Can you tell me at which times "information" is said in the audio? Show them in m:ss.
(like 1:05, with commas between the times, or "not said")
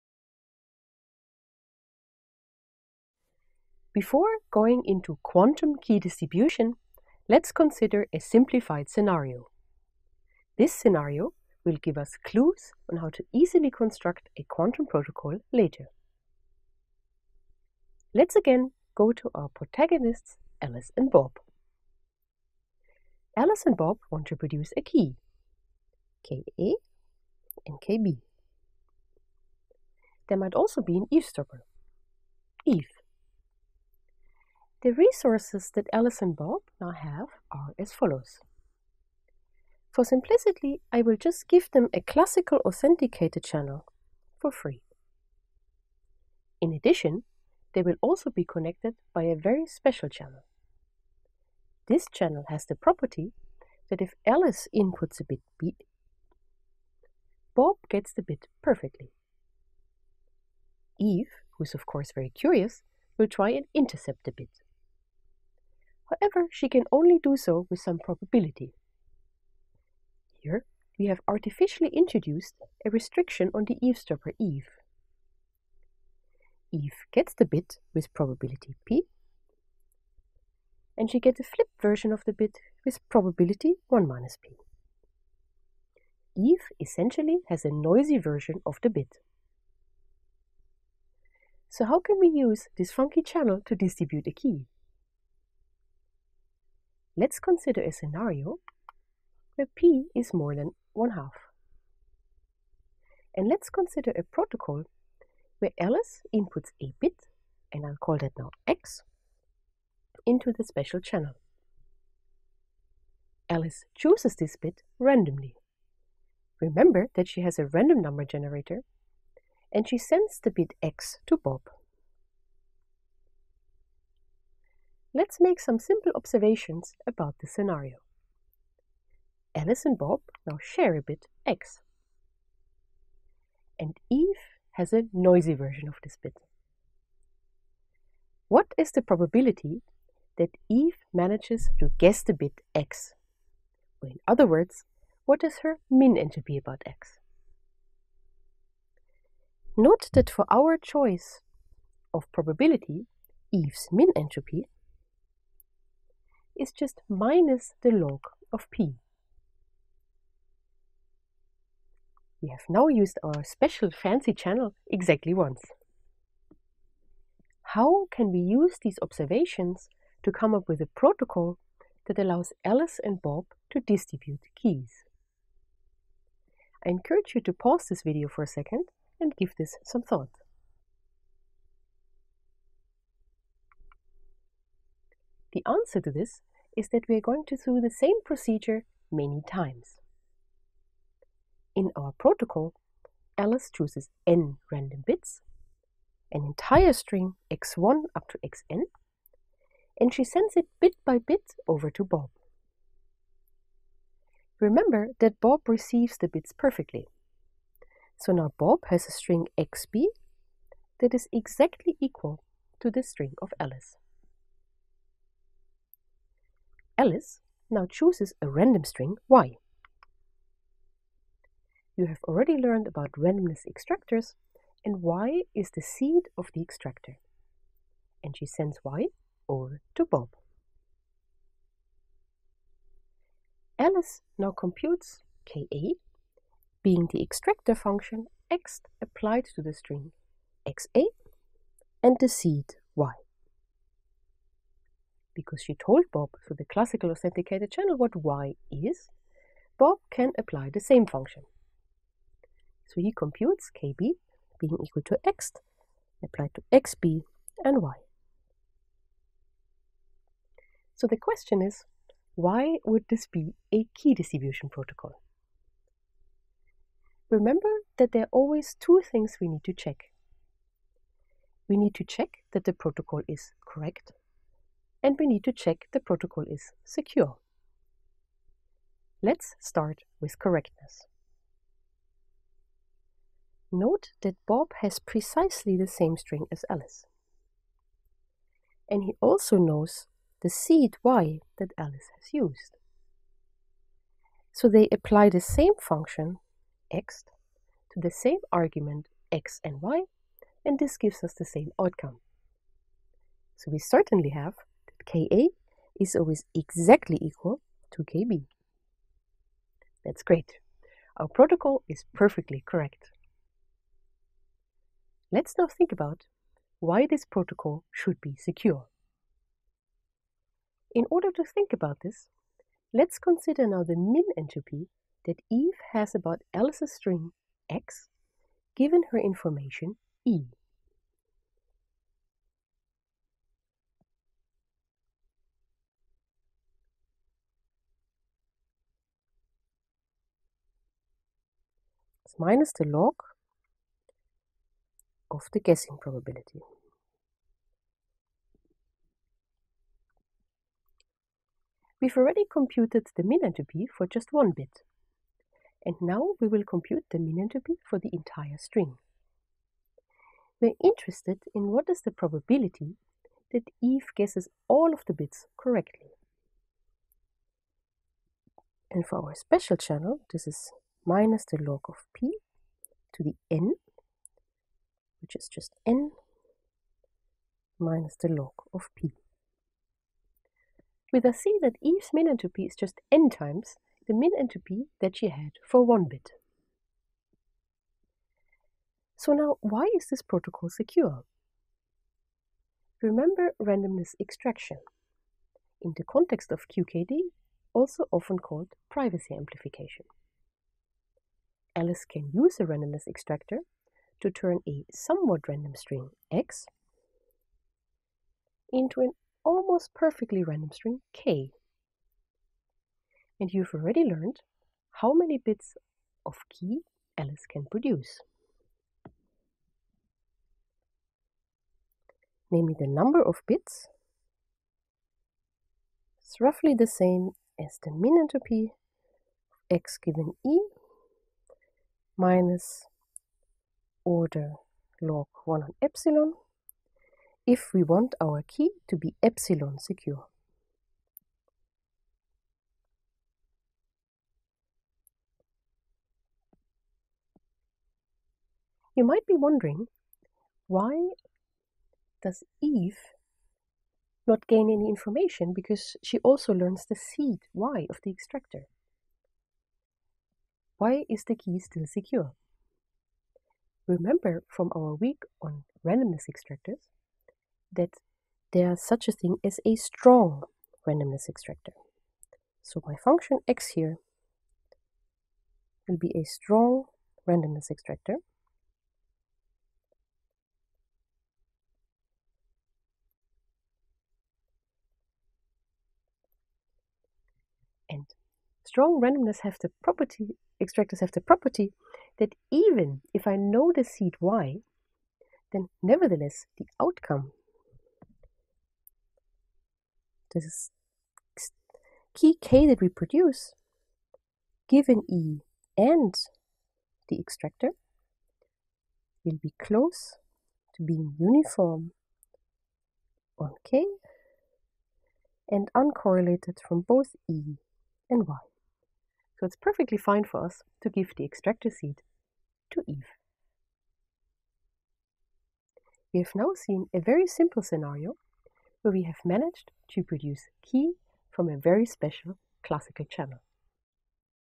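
5:29, 7:34.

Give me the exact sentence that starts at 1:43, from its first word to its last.
And let's consider a protocol where Alice inputs a bit, and I'll call that now x, into the special channel.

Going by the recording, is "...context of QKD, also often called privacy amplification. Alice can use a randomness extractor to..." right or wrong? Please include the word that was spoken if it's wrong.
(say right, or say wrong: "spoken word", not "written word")
right.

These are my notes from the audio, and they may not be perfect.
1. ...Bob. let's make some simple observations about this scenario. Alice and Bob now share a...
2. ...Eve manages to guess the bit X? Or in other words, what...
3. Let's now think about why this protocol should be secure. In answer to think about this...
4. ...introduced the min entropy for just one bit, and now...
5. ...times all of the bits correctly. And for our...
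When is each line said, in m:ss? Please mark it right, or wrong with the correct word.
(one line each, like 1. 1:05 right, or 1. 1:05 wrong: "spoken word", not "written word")
1. 2:01 right
2. 2:20 right
3. 5:15 wrong: "order", not "answer"
4. 5:52 wrong: "computed", not "introduced"
5. 6:04 wrong: "guesses", not "times".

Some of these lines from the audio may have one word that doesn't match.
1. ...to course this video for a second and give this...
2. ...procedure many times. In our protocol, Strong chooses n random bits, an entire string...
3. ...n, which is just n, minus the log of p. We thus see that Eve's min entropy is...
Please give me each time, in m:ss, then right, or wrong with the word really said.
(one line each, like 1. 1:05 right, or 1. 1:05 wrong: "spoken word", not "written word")
1. 2:57 wrong: "pause", not "course"
2. 3:08 wrong: "Alice", not "Strong"
3. 6:13 right.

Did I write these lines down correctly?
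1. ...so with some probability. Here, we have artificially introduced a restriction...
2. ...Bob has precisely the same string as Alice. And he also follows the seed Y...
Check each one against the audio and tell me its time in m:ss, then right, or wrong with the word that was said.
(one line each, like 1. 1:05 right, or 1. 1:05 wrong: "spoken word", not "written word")
1. 1:07 right
2. 4:44 wrong: "knows", not "follows".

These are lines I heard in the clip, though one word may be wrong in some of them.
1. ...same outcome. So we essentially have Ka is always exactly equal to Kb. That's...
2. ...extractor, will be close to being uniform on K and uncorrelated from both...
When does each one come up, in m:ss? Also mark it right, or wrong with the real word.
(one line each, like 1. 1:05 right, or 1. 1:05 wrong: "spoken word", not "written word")
1. 5:01 wrong: "certainly", not "essentially"
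2. 8:27 right.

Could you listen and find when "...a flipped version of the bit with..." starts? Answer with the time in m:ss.
1:21.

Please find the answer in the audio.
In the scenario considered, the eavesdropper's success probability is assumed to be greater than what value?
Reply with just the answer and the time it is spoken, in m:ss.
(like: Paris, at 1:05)
1/2, at 1:40.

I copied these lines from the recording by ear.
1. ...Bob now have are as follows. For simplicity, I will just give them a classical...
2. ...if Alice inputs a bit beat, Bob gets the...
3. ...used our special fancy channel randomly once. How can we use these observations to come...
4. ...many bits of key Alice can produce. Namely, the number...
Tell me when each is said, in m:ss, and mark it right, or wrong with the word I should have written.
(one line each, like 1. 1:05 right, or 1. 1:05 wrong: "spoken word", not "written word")
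1. 0:36 right
2. 0:54 right
3. 2:42 wrong: "exactly", not "randomly"
4. 6:55 right.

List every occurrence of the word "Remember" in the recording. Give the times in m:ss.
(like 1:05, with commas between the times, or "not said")
1:56, 3:24, 4:27, 6:33, 7:43.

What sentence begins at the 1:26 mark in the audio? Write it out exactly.
Eve essentially has a noisy version of the bit.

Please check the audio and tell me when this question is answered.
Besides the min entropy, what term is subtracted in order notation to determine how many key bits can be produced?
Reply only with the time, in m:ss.
7:15.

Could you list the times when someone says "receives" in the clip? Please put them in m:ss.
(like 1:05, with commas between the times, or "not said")
3:25.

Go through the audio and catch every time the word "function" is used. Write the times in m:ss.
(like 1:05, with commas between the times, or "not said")
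3:57, 4:11, 4:55, 7:52.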